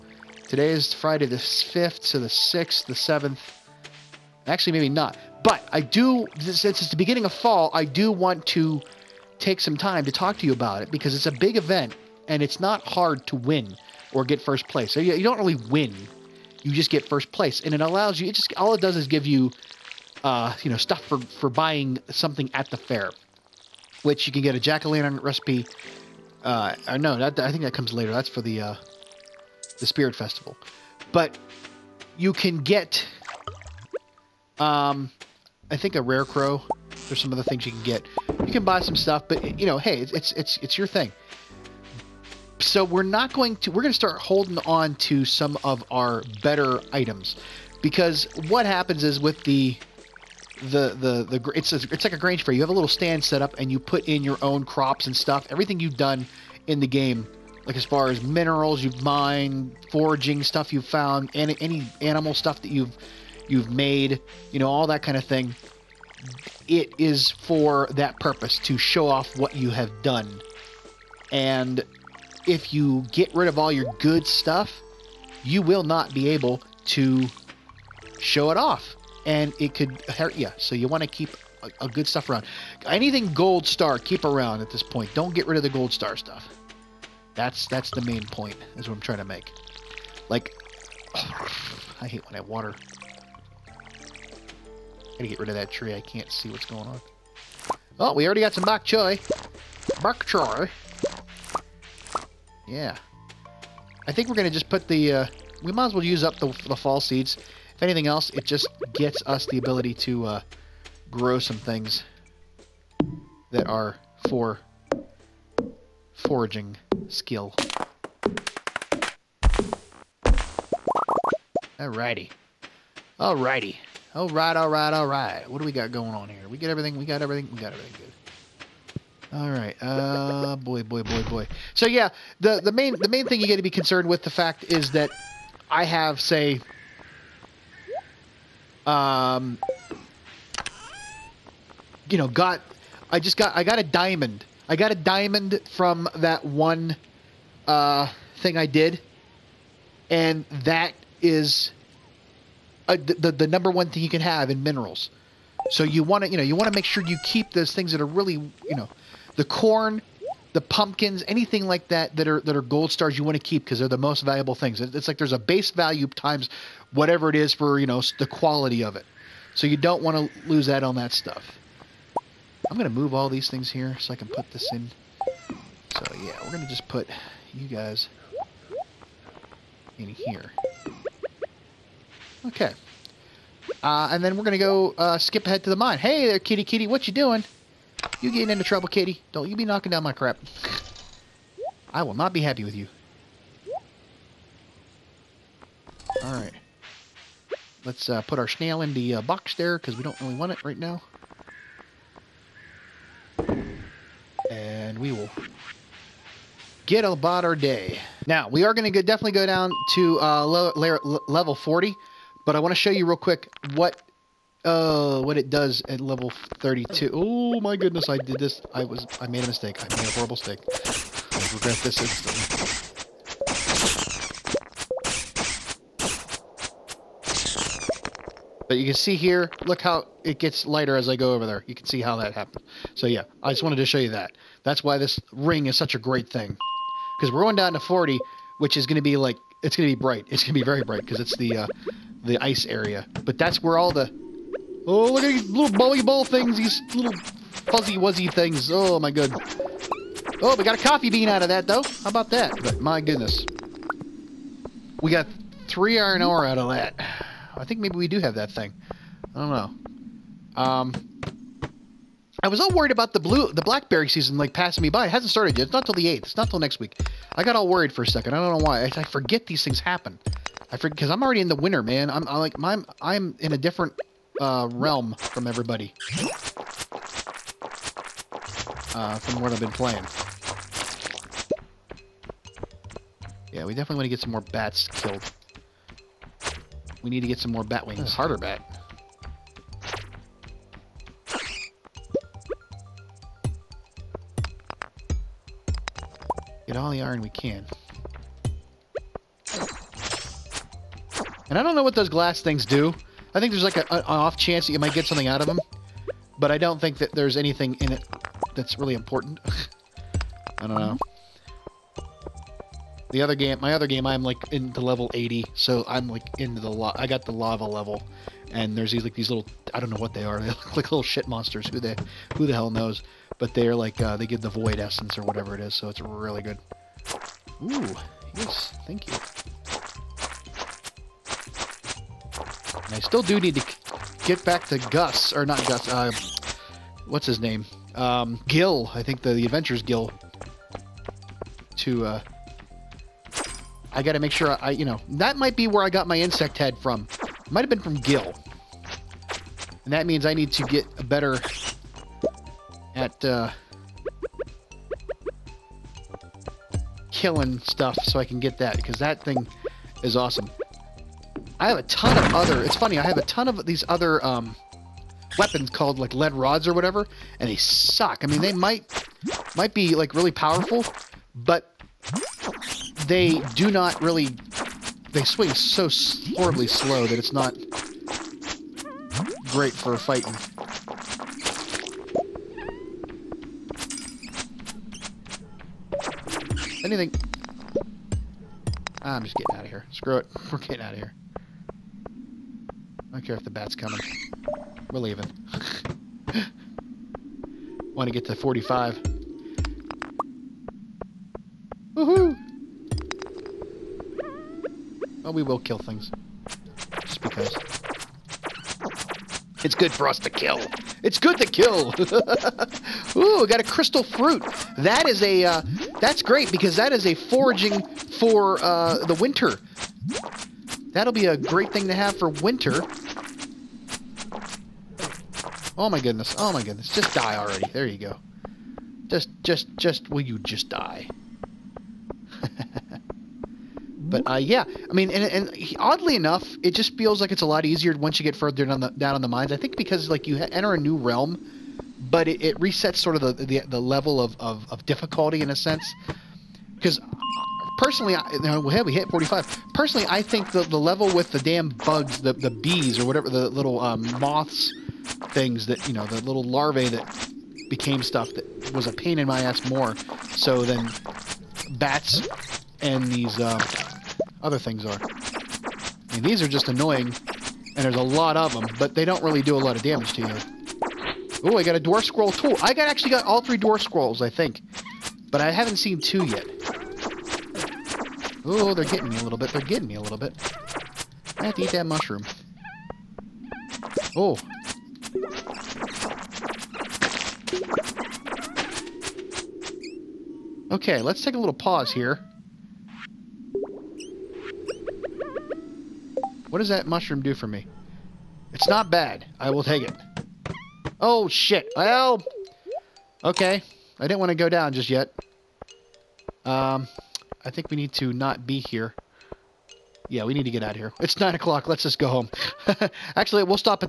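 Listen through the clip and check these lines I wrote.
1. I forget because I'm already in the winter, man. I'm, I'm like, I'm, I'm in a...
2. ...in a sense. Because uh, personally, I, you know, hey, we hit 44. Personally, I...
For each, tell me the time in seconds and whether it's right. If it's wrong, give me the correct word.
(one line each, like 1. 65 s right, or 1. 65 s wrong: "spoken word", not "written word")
1. 270 s right
2. 445 s wrong: "45", not "44".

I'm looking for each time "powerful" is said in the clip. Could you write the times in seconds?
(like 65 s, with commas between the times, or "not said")
370 s.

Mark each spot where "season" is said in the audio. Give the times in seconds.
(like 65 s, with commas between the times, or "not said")
264 s.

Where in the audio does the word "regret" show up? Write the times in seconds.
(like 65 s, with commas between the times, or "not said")
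221 s.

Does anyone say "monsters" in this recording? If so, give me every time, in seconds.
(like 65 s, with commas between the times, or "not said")
321 s.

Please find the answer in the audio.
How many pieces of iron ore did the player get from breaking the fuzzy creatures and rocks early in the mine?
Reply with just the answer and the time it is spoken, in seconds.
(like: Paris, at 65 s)
3, at 255 s.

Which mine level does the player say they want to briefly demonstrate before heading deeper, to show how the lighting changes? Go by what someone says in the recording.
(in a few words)
32.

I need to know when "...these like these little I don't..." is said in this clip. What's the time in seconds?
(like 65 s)
318 s.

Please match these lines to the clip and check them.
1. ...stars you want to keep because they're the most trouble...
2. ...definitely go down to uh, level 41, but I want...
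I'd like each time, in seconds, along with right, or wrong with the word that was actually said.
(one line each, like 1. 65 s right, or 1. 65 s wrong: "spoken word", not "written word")
1. 162 s wrong: "valuable", not "trouble"
2. 209 s wrong: "40", not "41".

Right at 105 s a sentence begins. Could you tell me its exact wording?
Uh, we might as well use up the, the fall seeds.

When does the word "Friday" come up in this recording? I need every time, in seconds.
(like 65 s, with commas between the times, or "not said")
0 s.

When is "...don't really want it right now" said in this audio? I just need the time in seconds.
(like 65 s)
200 s.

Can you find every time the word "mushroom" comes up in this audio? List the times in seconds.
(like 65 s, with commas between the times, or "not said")
481 s, 496 s.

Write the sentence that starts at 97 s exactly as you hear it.
Oh, we already got some bok choy.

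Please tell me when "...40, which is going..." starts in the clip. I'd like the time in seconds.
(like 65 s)
237 s.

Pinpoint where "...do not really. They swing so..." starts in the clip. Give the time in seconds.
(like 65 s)
373 s.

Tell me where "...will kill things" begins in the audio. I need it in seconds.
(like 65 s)
405 s.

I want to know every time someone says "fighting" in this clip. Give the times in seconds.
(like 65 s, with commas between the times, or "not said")
379 s.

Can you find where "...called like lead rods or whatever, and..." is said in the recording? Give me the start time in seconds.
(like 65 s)
365 s.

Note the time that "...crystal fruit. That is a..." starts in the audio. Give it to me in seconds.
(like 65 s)
413 s.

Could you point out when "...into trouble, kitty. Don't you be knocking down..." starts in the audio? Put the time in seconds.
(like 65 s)
188 s.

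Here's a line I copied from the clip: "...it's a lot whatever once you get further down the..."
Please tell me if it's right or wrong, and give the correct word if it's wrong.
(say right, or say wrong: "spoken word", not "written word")
wrong: "easier", not "whatever".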